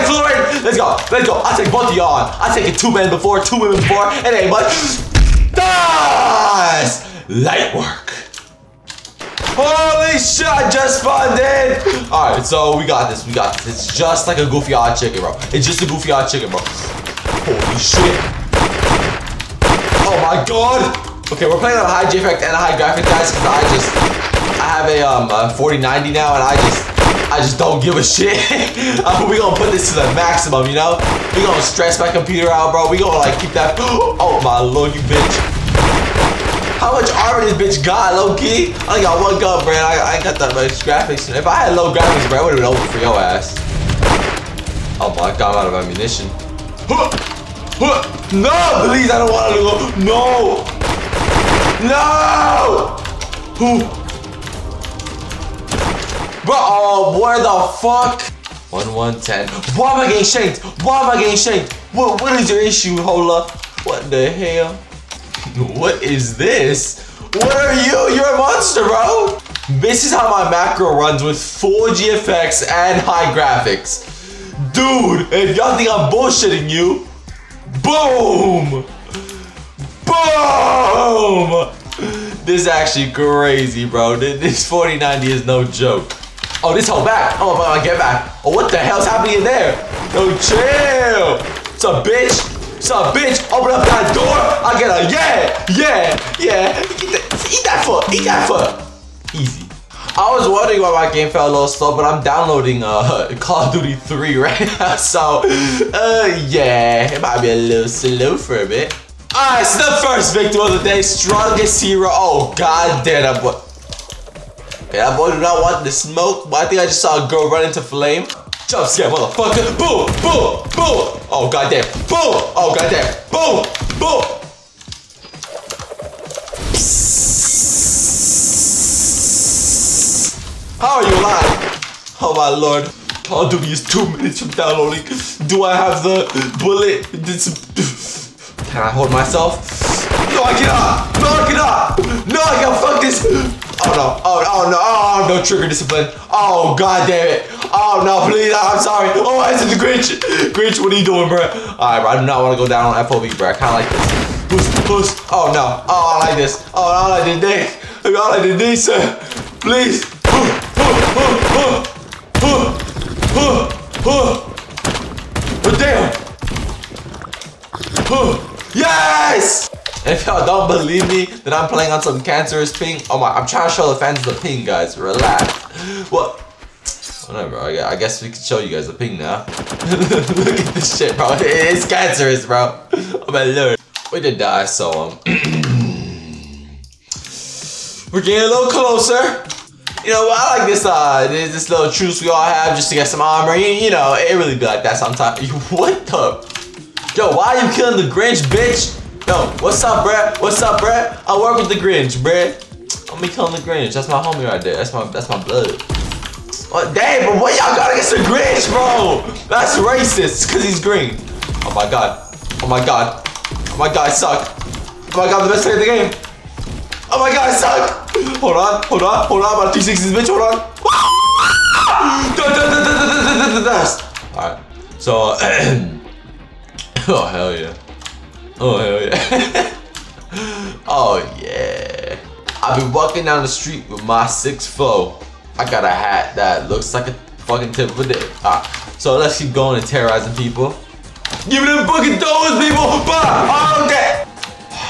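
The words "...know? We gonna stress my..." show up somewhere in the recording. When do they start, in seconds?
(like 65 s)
30 s.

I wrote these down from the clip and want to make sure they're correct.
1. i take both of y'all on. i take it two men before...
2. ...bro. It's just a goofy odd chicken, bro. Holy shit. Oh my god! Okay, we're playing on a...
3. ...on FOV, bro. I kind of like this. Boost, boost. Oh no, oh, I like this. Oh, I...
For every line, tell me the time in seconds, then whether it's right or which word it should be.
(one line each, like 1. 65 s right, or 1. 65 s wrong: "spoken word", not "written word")
1. 1 s right
2. 15 s right
3. 152 s right.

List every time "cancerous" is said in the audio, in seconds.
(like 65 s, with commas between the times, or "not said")
172 s, 181 s.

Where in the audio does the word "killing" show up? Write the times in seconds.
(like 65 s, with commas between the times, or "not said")
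197 s, 203 s.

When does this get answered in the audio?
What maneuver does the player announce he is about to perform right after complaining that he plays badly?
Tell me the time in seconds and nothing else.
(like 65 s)
219 s.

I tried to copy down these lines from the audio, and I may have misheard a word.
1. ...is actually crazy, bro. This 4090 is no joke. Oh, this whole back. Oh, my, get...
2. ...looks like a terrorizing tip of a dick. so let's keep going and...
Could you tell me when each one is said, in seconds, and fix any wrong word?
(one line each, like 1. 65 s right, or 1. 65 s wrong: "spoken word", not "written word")
1. 82 s right
2. 236 s wrong: "fucking", not "terrorizing".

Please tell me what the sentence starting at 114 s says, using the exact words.
Okay, that boy do not want the smoke, but I think I just saw a girl run into flame.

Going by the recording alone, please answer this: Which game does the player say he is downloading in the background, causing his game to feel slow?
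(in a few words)
Call of Duty 3.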